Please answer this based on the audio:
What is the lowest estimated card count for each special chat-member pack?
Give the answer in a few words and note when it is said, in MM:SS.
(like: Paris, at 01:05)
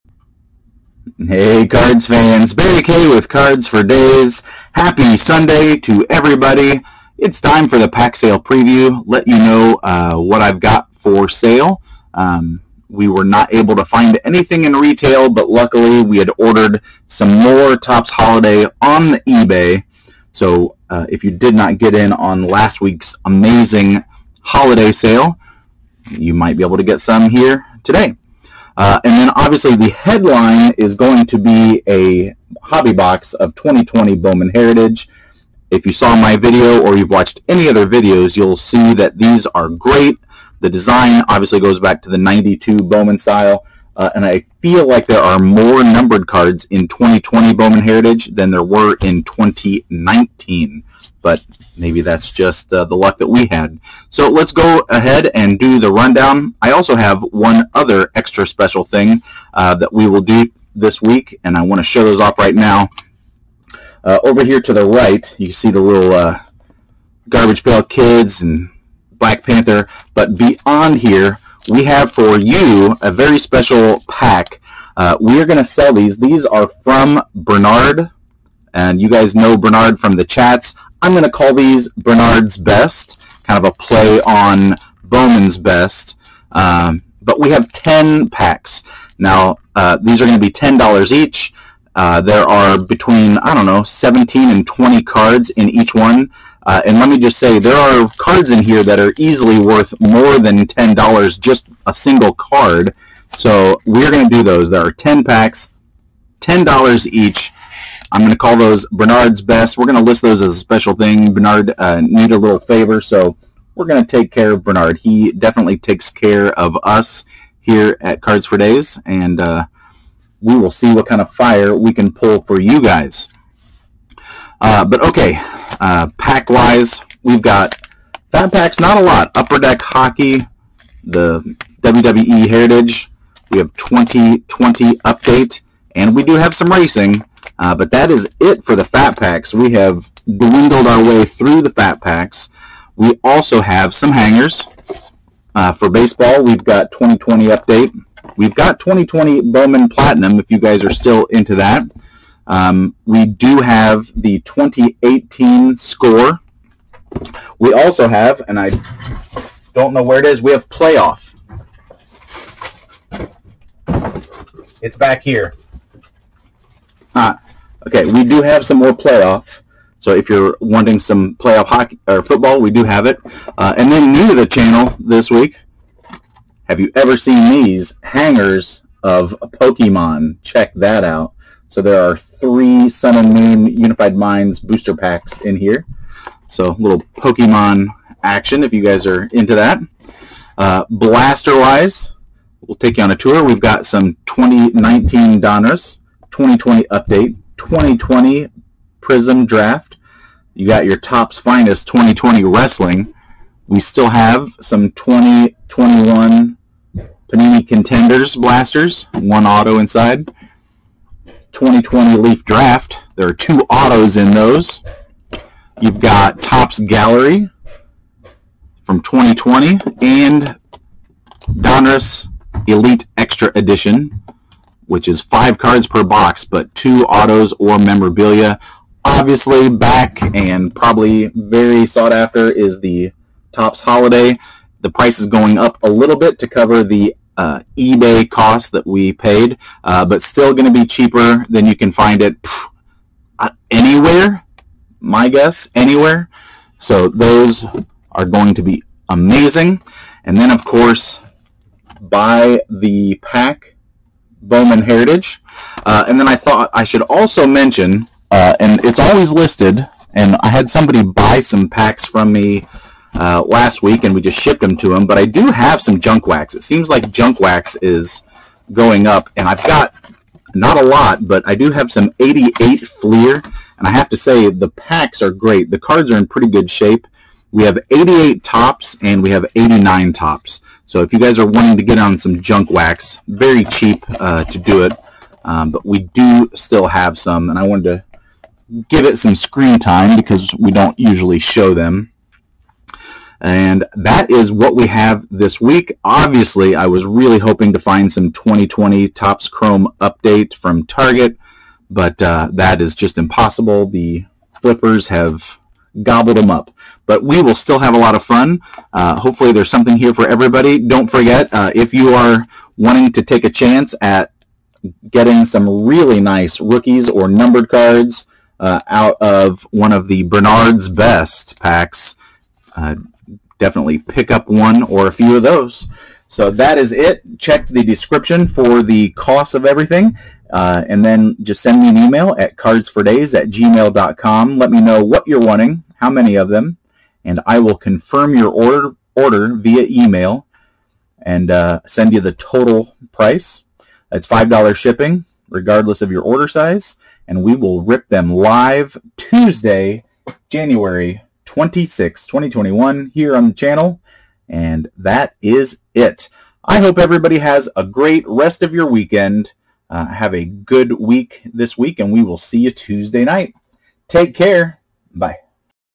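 17, at 01:33.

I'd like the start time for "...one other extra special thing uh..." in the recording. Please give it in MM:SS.
00:57.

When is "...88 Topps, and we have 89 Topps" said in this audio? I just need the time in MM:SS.
04:37.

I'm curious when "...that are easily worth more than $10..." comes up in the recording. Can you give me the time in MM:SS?
01:38.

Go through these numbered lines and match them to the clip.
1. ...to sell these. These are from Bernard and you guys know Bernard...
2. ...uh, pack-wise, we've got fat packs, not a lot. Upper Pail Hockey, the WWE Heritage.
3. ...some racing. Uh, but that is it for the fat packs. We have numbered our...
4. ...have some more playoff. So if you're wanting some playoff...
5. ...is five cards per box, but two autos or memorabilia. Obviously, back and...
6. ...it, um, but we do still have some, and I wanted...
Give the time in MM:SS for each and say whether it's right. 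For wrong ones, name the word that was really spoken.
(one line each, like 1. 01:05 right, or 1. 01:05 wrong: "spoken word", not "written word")
1. 01:15 right
2. 02:05 wrong: "Deck", not "Pail"
3. 02:16 wrong: "dwindled", not "numbered"
4. 02:48 right
5. 03:45 right
6. 04:44 right.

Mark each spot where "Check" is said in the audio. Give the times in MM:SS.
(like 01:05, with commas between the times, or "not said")
03:00, 05:27.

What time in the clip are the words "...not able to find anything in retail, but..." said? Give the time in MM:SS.
00:13.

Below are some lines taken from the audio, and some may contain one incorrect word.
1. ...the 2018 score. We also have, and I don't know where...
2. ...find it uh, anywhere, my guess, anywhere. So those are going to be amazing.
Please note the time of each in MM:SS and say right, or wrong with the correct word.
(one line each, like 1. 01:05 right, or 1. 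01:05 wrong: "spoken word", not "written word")
1. 02:34 right
2. 04:01 right.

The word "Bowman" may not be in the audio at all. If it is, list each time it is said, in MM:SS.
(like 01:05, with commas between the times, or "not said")
00:34, 00:42, 00:47, 01:25, 02:29, 04:14.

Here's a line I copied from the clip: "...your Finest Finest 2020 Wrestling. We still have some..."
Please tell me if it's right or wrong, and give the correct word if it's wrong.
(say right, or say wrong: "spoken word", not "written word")
wrong: "Topps", not "Finest".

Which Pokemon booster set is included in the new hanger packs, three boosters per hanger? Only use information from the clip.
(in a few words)
Sun and Moon Unified Minds.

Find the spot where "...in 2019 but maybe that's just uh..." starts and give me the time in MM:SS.
00:49.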